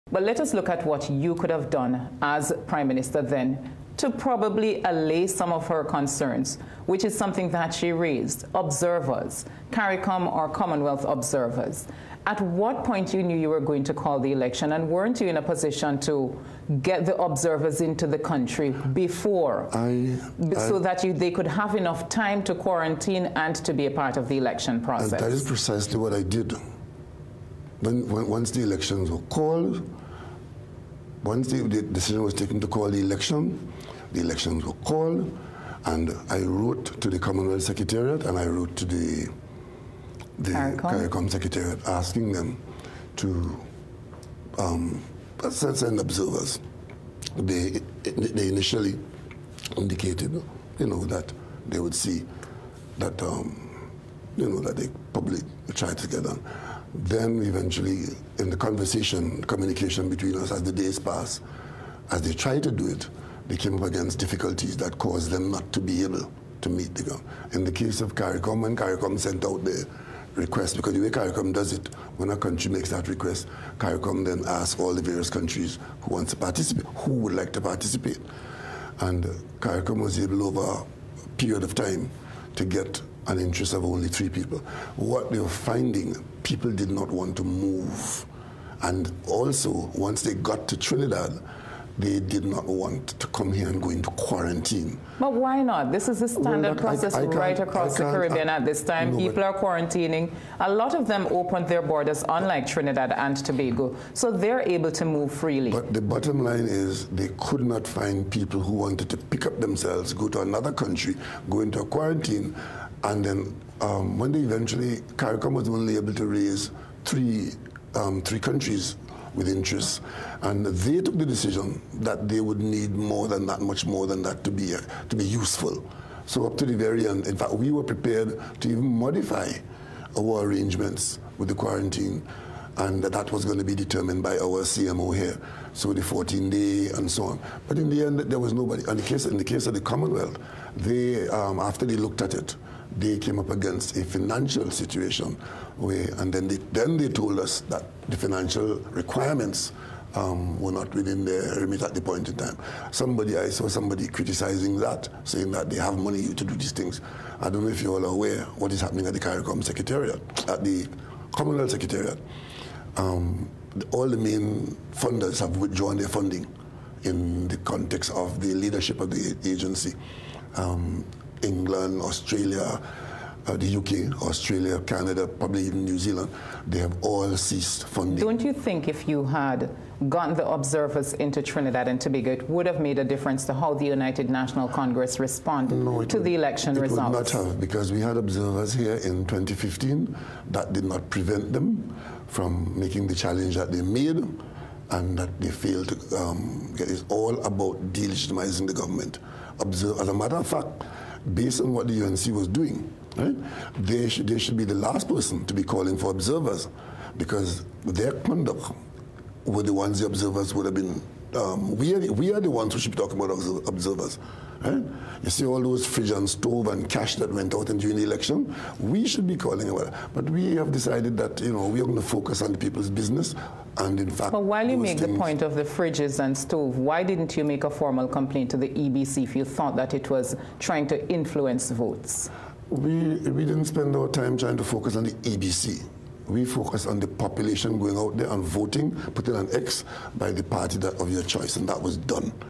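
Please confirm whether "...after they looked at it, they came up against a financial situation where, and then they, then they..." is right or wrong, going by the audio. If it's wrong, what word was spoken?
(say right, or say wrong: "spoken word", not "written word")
right.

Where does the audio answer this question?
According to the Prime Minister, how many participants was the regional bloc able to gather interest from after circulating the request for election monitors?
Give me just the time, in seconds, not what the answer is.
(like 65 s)
84 s.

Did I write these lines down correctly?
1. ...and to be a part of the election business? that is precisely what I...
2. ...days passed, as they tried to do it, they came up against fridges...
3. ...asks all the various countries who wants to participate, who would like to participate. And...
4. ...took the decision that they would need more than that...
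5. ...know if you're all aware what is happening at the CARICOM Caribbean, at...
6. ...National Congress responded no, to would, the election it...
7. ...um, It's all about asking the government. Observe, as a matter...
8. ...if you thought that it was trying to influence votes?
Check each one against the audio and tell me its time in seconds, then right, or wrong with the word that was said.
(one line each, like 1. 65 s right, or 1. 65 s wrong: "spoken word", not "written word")
1. 23 s wrong: "process", not "business"
2. 60 s wrong: "difficulties", not "fridges"
3. 74 s right
4. 121 s right
5. 157 s wrong: "Secretariat", not "Caribbean"
6. 184 s right
7. 196 s wrong: "delegitimizing", not "asking"
8. 229 s right.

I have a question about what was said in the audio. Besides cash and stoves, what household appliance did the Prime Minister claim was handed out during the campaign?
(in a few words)
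Fridge.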